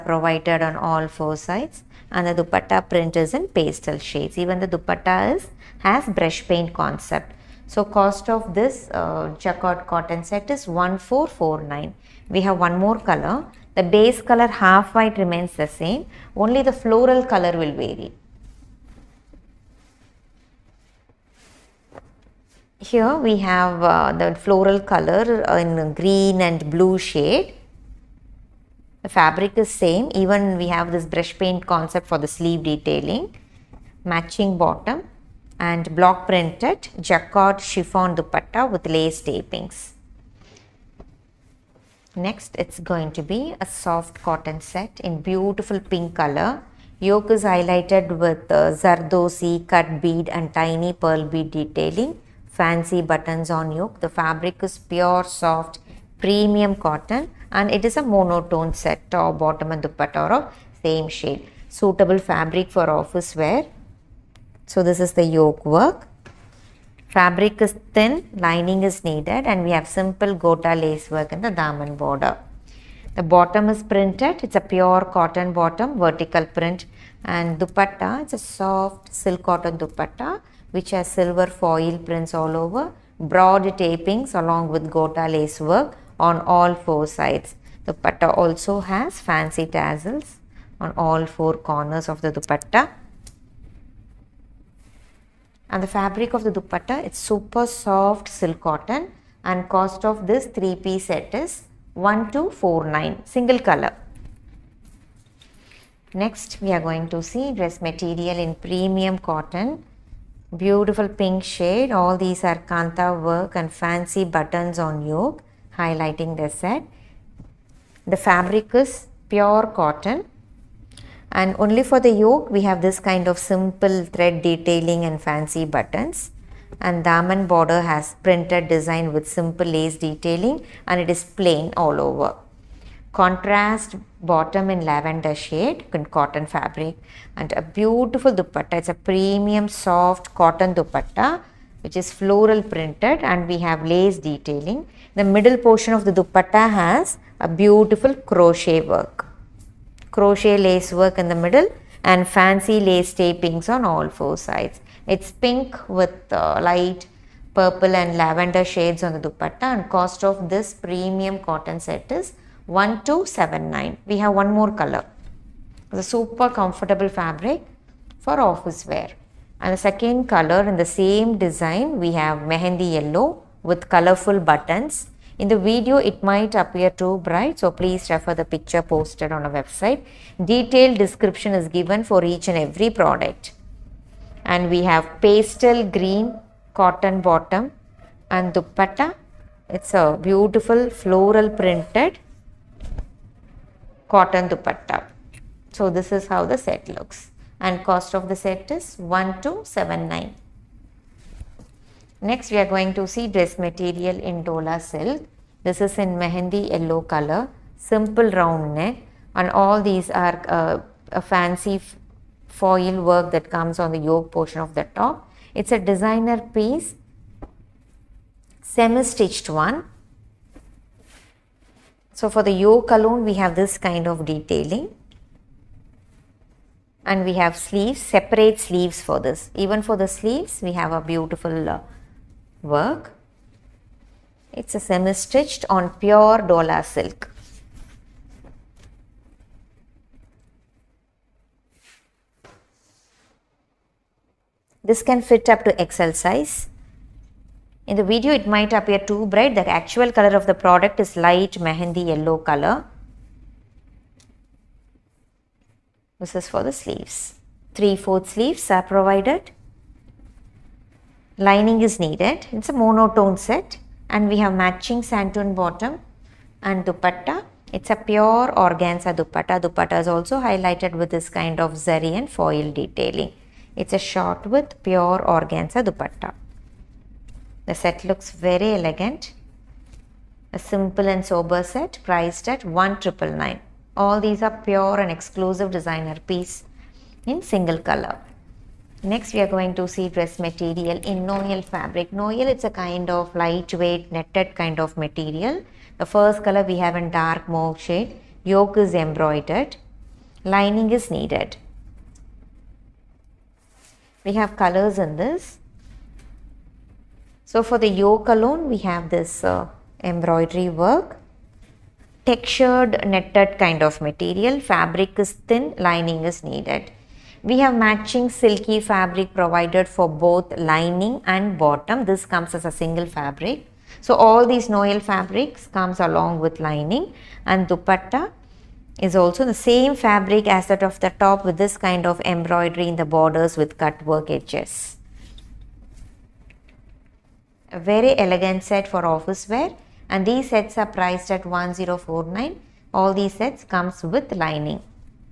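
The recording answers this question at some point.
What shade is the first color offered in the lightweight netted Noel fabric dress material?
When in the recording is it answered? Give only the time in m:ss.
4:57.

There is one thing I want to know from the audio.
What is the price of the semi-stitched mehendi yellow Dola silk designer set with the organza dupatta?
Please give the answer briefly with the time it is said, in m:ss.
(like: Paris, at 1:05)
1999, at 4:42.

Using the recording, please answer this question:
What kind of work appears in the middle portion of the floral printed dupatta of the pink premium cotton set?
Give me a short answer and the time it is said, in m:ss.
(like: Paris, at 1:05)
Crochet lace work, at 2:30.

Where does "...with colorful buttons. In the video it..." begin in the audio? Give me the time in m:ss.
2:53.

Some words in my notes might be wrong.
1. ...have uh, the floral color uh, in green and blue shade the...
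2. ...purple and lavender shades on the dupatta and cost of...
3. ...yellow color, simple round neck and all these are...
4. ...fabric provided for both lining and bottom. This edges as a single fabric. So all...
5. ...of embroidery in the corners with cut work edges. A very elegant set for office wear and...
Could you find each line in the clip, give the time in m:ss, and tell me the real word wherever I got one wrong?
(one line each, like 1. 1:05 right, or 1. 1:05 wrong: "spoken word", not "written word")
1. 0:23 right
2. 2:37 right
3. 3:26 right
4. 5:18 wrong: "comes", not "edges"
5. 5:32 wrong: "borders", not "corners".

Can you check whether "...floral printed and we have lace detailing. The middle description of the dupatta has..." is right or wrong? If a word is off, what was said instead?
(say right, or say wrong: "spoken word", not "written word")
wrong: "portion", not "description".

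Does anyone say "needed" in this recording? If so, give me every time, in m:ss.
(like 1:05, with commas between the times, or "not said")
1:09, 4:21, 5:01, 5:16.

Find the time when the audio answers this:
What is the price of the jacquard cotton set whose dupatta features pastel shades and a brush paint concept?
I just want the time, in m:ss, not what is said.
0:10.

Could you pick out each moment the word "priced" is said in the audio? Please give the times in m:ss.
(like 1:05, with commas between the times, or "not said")
4:42, 5:40.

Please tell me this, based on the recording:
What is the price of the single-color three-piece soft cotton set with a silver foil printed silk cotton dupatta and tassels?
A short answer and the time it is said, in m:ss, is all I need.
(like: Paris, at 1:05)
1249, at 1:41.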